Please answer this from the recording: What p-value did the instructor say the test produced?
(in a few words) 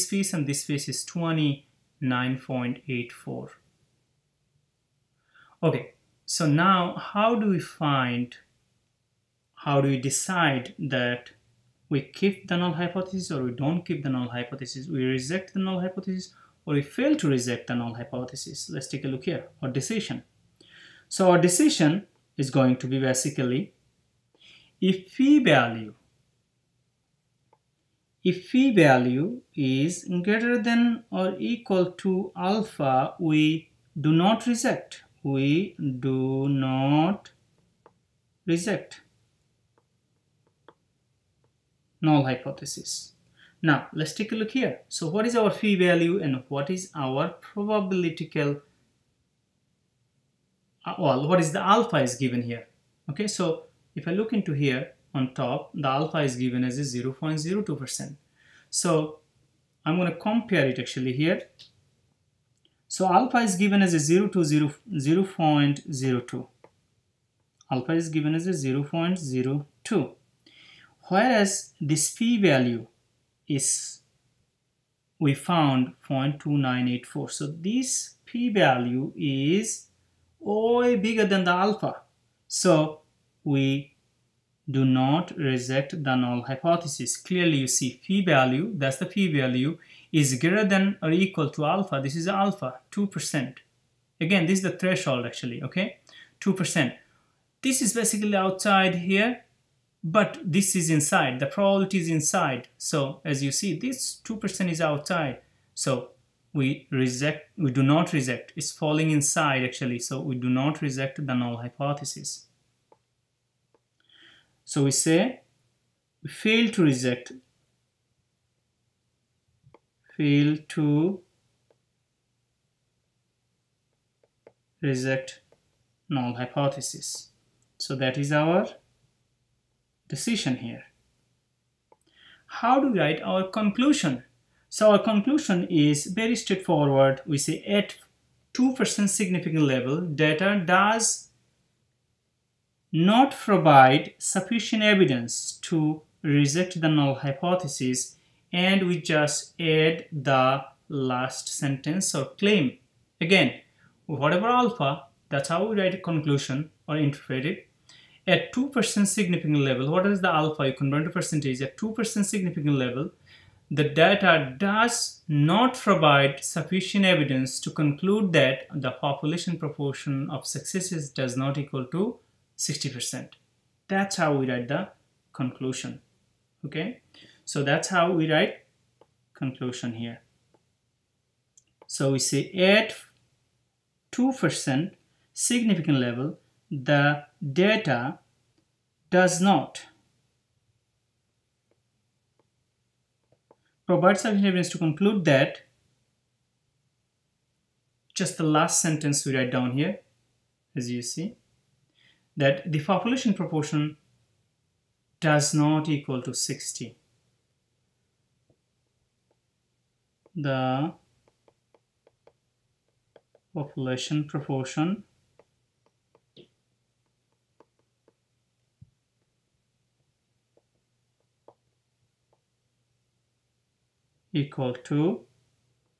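0.2984.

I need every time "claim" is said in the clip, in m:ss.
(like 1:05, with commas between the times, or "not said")
2:32.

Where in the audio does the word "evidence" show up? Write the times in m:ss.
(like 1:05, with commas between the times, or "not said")
2:24, 2:47, 3:14.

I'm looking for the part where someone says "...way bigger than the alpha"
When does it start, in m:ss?
1:20.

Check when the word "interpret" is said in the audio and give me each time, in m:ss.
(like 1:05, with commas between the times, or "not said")
2:36.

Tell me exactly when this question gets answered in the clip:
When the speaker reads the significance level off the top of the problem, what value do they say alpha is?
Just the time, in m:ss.
1:07.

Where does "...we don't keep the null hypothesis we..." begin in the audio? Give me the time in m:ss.
0:13.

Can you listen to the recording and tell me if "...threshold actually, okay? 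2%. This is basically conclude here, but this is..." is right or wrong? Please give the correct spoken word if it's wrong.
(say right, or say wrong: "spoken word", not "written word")
wrong: "outside", not "conclude".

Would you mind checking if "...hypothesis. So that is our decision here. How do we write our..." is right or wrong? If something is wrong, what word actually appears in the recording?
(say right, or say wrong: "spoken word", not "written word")
right.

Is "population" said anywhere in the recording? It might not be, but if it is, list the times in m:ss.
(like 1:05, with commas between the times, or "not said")
2:48, 3:22, 3:33.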